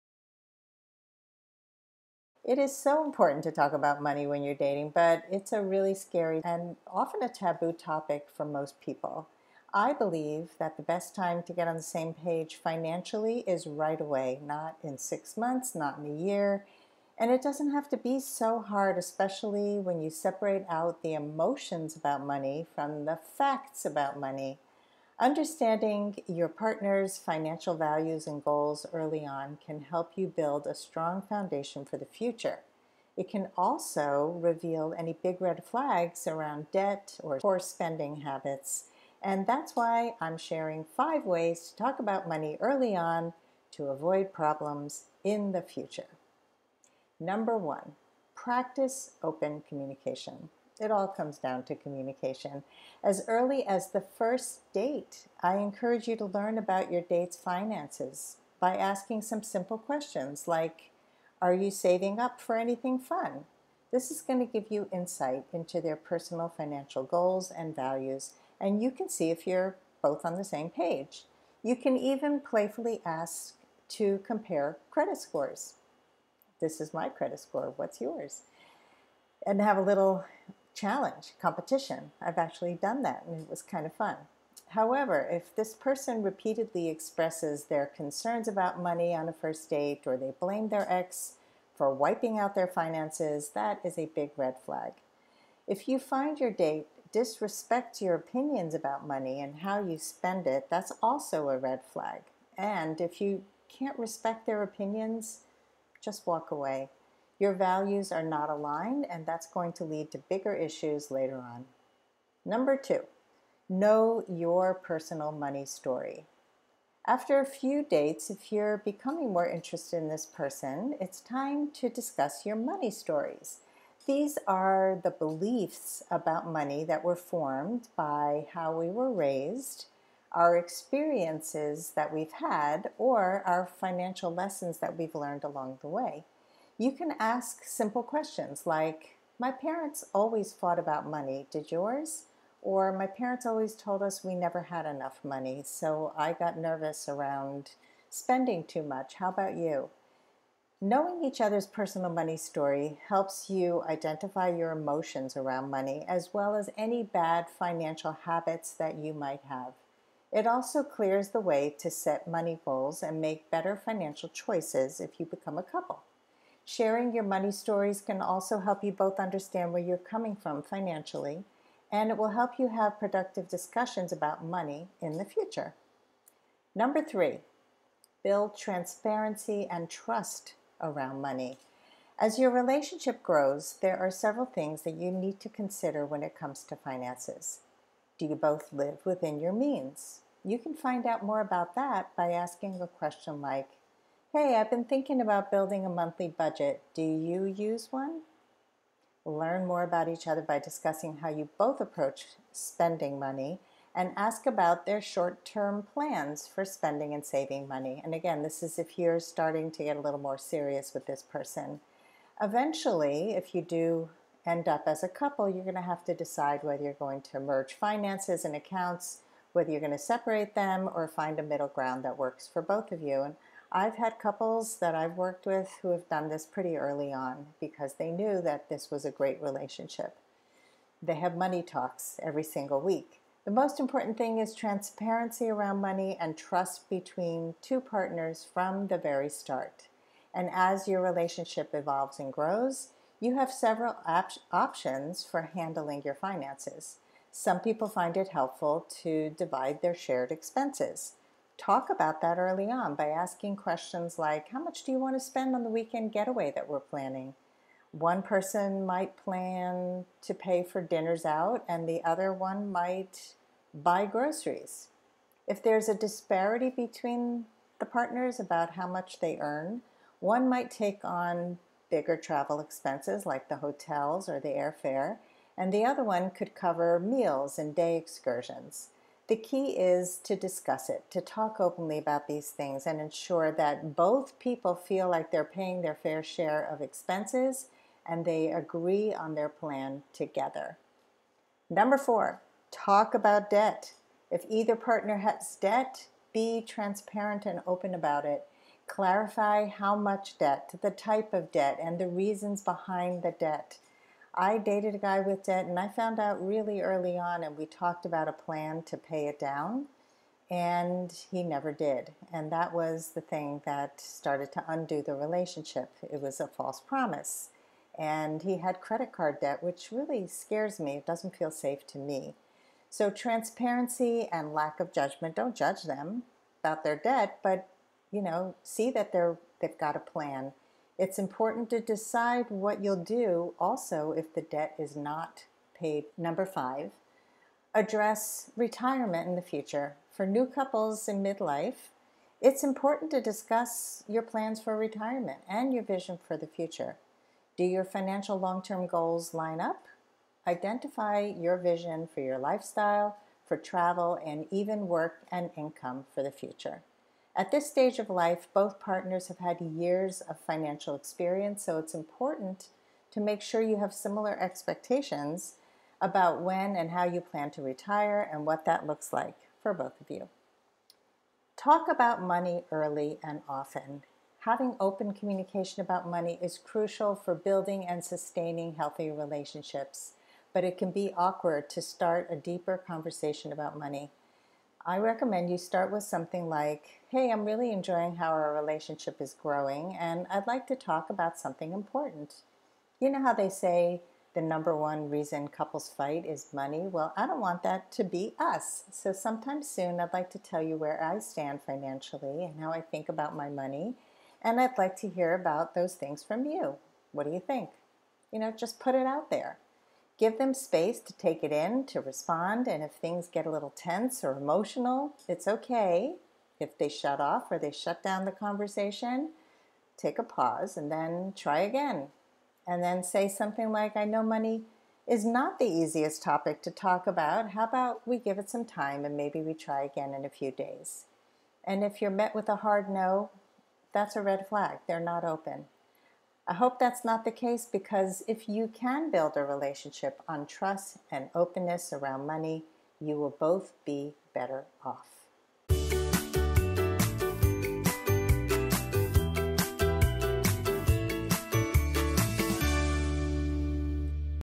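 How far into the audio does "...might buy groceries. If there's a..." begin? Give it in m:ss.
4:22.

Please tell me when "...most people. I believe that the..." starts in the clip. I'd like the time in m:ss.
0:08.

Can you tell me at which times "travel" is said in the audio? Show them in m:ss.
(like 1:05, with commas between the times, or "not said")
4:32, 5:53.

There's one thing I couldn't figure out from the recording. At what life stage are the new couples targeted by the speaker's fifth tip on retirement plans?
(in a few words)
Midlife.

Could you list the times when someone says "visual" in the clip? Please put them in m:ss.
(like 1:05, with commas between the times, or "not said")
not said.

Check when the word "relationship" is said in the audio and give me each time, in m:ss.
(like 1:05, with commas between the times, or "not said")
3:02, 3:49, 4:01, 5:15, 6:19, 6:28, 7:19.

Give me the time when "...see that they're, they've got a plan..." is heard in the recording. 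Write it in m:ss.
5:28.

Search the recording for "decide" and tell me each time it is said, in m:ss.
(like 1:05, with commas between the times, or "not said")
3:36, 5:31.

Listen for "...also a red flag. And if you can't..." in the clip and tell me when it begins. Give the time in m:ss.
1:41.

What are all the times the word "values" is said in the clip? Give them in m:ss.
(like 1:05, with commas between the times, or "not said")
0:27, 1:07, 1:47.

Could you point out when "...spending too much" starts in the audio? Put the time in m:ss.
2:28.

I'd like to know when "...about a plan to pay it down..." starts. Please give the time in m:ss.
5:08.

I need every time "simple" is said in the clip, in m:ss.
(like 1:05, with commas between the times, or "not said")
0:59, 2:17.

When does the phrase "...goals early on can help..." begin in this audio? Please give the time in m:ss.
0:28.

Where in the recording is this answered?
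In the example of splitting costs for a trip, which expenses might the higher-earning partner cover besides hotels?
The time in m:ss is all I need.
4:34.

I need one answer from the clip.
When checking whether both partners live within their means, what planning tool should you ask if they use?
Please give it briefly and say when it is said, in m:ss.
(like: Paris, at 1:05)
Monthly budget, at 3:15.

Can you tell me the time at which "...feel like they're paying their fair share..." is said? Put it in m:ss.
4:44.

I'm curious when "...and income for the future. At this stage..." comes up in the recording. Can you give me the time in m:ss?
5:55.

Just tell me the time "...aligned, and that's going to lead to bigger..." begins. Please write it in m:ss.
1:48.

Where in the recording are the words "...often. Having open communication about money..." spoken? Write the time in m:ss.
6:13.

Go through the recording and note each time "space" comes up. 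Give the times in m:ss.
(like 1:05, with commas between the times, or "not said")
6:50.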